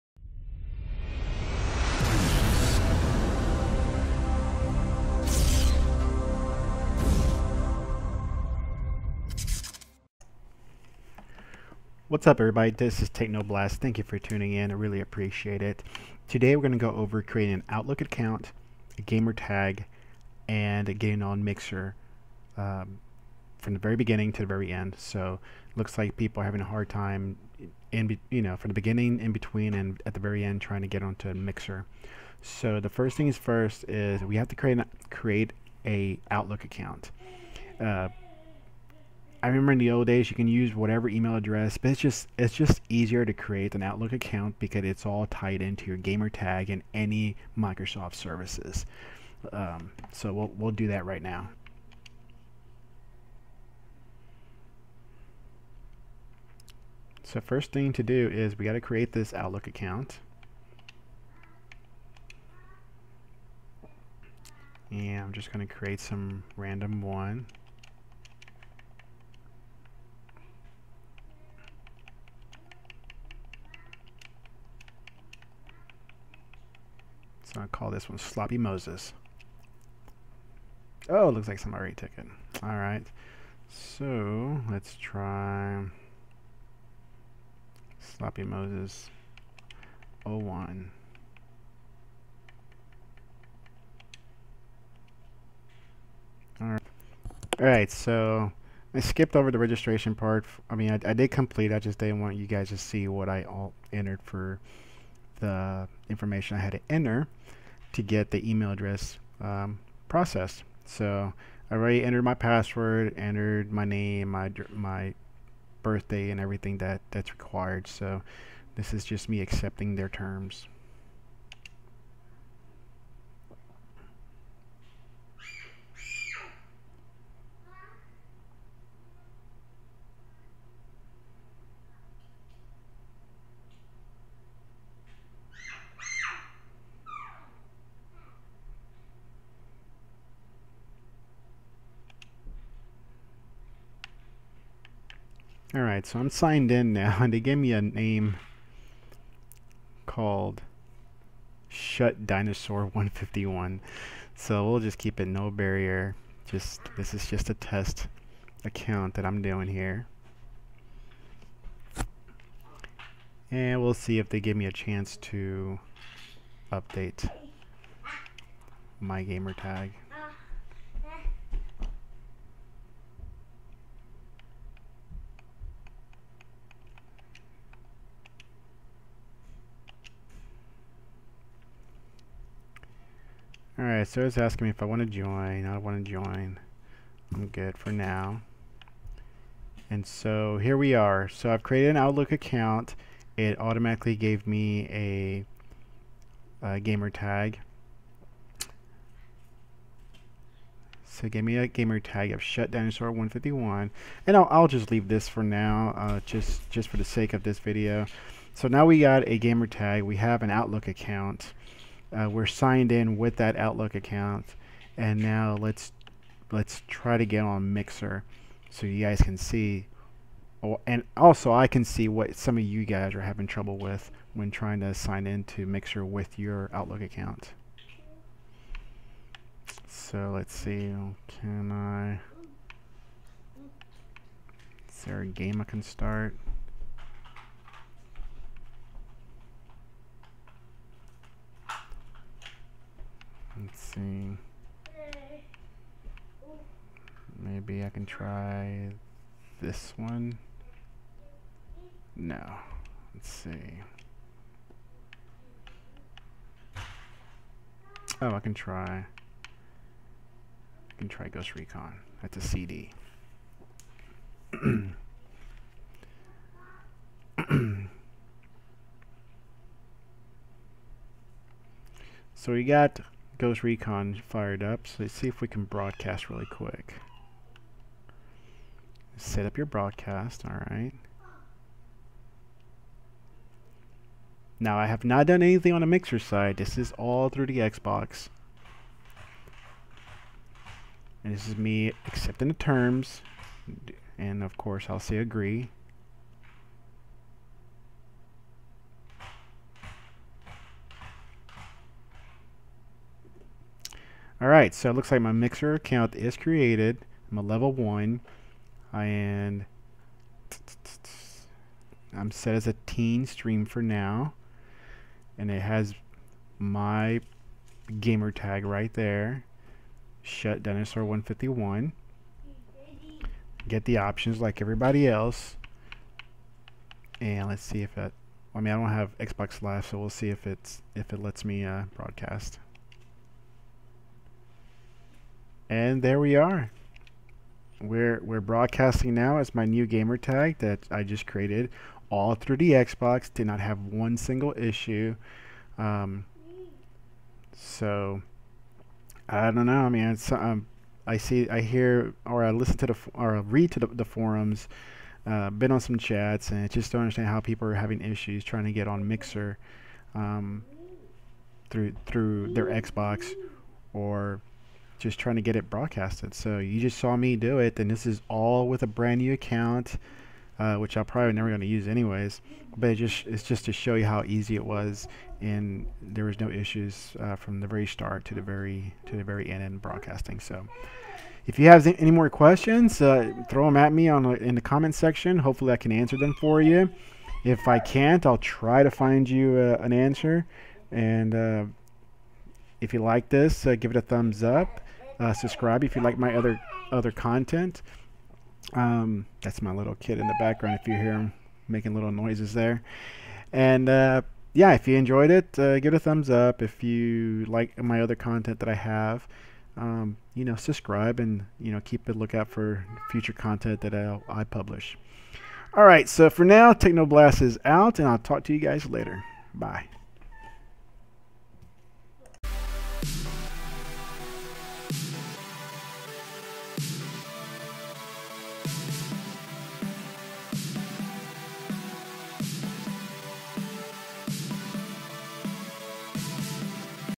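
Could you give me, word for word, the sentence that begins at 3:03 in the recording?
Alright, Sarah's asking me if I want to join.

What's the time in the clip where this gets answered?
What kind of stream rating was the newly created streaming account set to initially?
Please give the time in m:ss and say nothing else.
5:12.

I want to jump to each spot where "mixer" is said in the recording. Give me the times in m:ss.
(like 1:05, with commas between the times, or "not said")
0:21, 0:31, 3:37, 3:45, 4:45, 5:05, 5:59.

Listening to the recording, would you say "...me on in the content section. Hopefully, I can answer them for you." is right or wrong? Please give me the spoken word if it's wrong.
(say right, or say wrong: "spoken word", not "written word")
wrong: "comment", not "content".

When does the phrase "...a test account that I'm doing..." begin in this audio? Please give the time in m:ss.
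2:37.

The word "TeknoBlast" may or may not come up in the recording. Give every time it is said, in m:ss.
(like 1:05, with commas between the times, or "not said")
0:13, 6:56.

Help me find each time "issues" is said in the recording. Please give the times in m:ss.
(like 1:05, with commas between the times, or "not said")
5:44, 5:58, 6:16.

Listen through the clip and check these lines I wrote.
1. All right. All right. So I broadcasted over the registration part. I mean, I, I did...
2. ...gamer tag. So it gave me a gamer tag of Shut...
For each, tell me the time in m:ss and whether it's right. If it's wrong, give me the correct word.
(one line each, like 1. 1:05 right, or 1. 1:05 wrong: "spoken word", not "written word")
1. 1:36 wrong: "skipped", not "broadcasted"
2. 3:16 right.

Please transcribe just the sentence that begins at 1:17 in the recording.
So I'll call this one Sloppy Moses.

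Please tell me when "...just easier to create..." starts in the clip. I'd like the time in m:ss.
0:42.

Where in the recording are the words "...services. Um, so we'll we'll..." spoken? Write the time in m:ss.
0:48.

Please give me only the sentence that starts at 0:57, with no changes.
So first thing to do is we got to create this Outlook account.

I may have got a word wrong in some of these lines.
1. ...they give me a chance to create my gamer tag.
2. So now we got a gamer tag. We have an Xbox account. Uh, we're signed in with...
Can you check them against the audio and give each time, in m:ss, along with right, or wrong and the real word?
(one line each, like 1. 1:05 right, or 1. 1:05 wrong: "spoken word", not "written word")
1. 2:44 wrong: "update", not "create"
2. 3:28 wrong: "Outlook", not "Xbox".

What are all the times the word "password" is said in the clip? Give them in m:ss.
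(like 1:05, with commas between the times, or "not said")
1:52.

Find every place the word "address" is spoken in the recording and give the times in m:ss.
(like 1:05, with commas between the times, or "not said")
0:41, 1:48.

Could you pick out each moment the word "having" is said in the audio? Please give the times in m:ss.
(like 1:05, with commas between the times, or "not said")
0:26, 3:43, 5:57.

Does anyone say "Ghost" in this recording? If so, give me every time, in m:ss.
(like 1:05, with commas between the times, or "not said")
4:21, 4:33.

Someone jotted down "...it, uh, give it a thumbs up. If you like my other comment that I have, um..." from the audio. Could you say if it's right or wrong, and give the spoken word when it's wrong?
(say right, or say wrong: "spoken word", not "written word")
wrong: "content", not "comment".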